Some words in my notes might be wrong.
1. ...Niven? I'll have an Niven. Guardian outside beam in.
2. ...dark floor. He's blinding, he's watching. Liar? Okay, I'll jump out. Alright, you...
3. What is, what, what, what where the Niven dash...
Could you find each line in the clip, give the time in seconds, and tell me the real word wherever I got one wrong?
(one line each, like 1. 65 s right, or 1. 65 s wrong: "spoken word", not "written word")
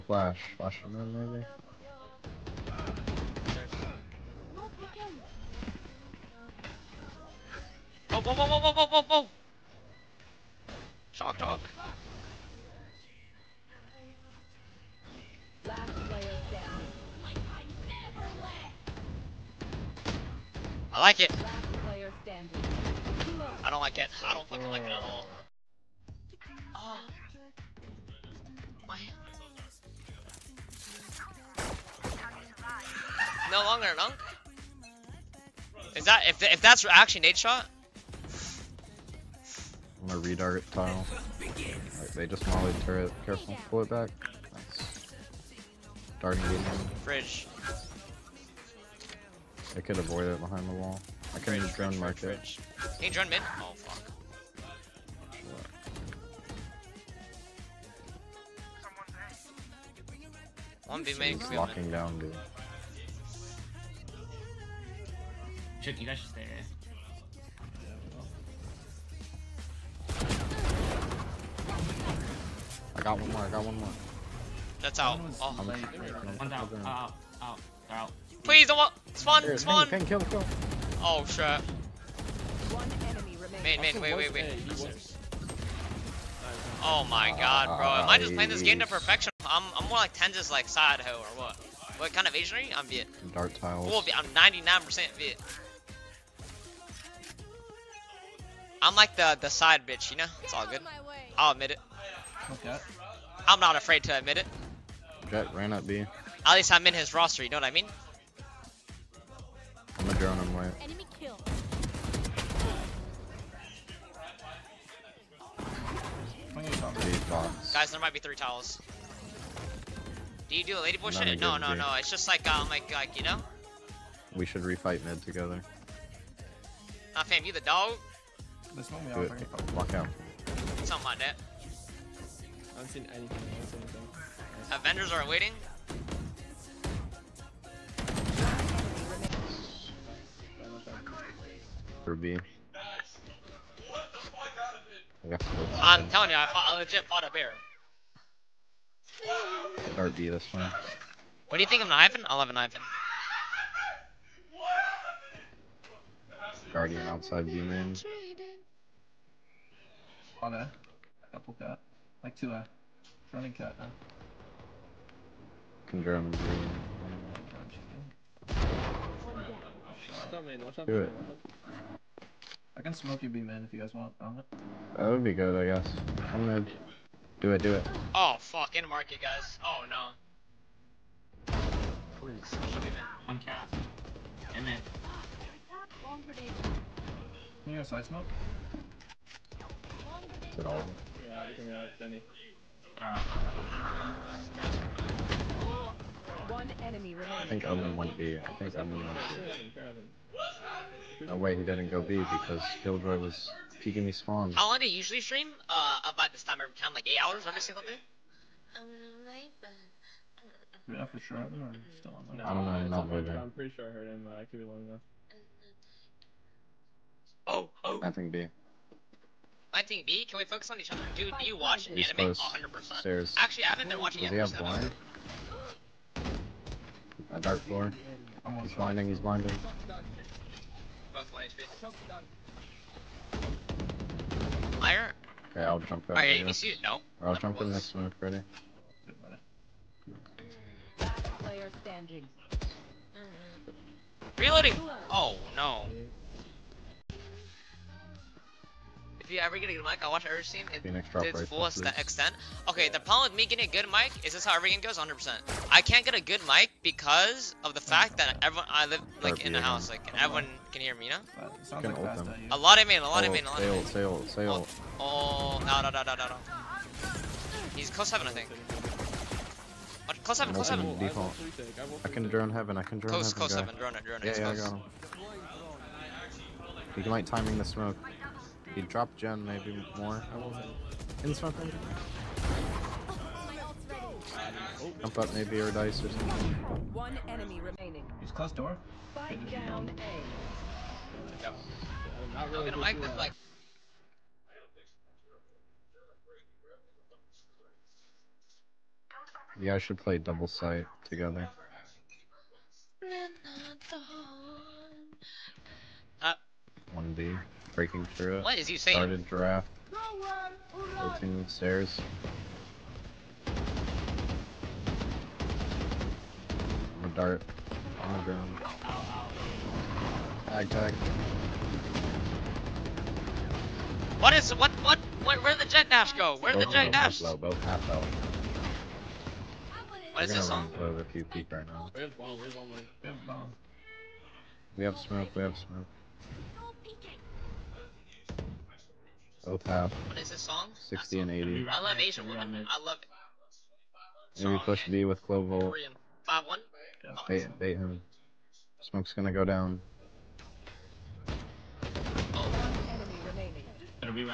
1. 151 s right
2. 227 s wrong: "blinding", not "watching"
3. 324 s wrong: "Jett", not "Niven".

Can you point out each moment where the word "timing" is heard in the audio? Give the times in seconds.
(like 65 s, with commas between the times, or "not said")
277 s.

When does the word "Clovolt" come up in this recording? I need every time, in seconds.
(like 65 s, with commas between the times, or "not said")
345 s.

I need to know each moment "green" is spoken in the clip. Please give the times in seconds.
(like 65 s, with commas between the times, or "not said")
166 s.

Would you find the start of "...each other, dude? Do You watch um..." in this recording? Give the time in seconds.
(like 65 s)
220 s.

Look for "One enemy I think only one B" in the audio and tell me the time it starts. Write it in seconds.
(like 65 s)
196 s.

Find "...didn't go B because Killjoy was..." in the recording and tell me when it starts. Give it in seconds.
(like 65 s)
201 s.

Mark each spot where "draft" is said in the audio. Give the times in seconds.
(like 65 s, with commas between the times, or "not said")
309 s.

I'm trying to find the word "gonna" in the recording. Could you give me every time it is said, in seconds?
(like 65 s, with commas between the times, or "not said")
40 s, 176 s, 292 s, 349 s.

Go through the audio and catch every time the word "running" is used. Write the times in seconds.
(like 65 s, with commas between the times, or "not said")
163 s.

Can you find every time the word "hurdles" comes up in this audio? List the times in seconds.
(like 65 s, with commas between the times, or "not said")
not said.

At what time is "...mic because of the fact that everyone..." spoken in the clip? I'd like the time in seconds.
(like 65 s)
256 s.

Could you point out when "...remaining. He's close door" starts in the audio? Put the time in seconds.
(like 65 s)
287 s.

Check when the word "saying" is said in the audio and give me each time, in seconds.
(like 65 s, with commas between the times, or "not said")
308 s.